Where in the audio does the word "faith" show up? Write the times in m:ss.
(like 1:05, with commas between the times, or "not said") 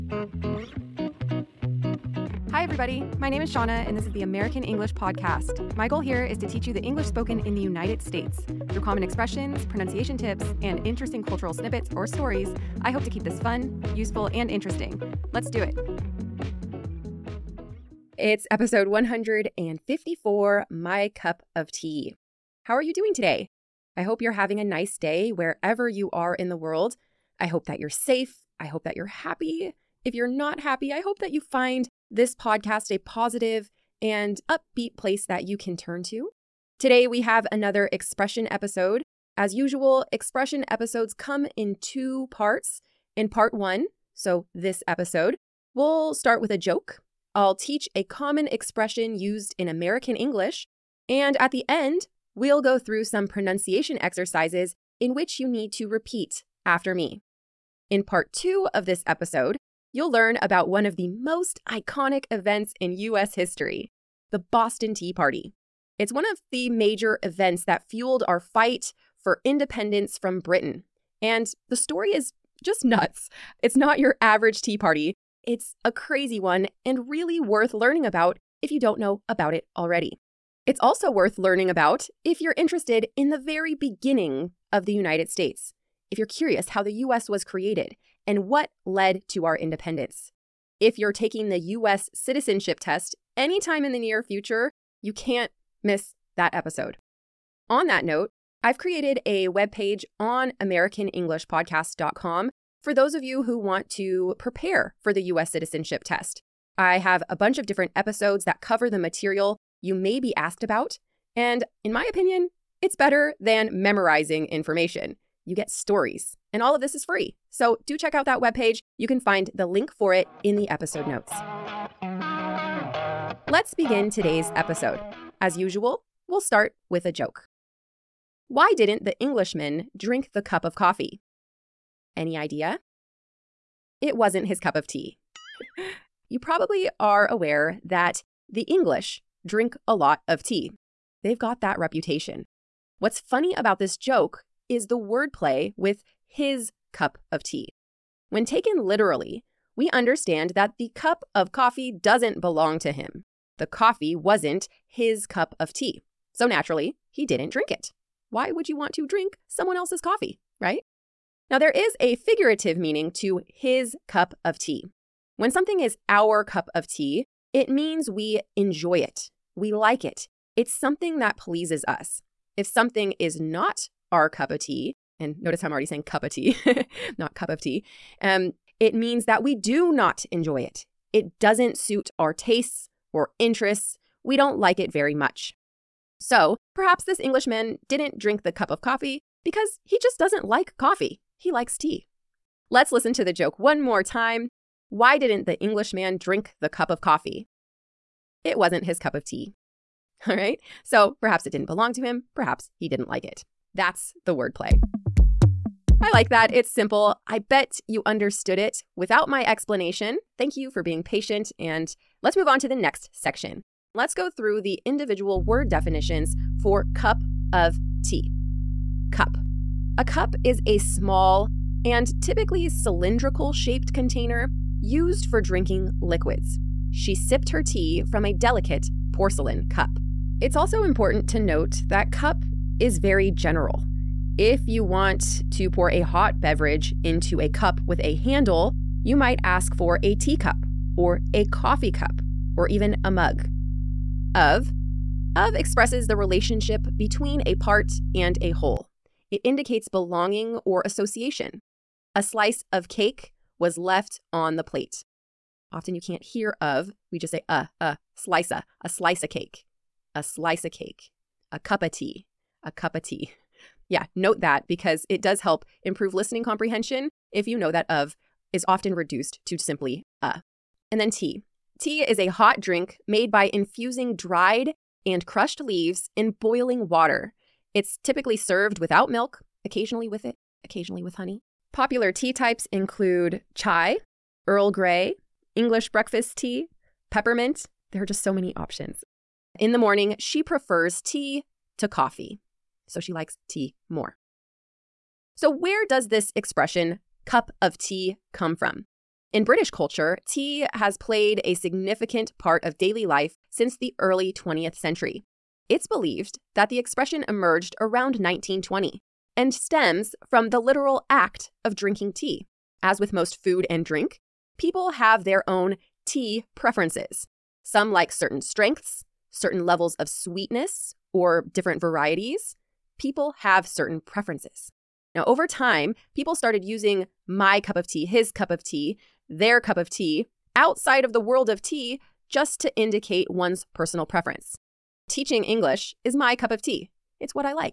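not said.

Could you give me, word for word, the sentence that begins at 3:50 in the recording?
It's also important to note that cup is very general.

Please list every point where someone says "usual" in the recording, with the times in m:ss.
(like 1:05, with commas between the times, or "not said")
0:39, 2:05.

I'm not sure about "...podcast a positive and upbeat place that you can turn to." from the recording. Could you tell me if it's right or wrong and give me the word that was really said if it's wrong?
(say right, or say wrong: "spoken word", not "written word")
right.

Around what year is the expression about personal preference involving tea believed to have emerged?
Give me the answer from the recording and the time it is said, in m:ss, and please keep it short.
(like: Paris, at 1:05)
1920, at 5:08.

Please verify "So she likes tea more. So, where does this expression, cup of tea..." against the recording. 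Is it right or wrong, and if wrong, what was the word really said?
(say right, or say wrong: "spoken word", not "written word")
right.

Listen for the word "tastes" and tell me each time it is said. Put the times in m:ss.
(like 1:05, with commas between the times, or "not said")
3:02.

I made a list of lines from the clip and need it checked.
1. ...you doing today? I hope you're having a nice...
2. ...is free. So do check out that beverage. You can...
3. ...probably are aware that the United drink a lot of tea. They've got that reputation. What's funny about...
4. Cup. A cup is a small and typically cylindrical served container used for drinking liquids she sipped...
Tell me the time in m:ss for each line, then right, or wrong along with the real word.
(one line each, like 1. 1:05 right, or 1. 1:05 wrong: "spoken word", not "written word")
1. 0:22 right
2. 1:56 wrong: "webpage", not "beverage"
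3. 2:16 wrong: "English", not "United"
4. 3:39 wrong: "shaped", not "served".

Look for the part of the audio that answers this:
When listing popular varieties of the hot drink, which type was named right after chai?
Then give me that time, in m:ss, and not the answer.
4:44.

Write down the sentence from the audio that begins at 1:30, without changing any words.
If you're taking the US citizenship test anytime in the near future, you can't miss that episode.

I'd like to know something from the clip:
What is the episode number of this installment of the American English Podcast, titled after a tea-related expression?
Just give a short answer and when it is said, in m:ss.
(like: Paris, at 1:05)
154, at 0:18.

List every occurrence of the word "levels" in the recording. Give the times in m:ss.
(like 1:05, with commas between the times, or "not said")
5:19.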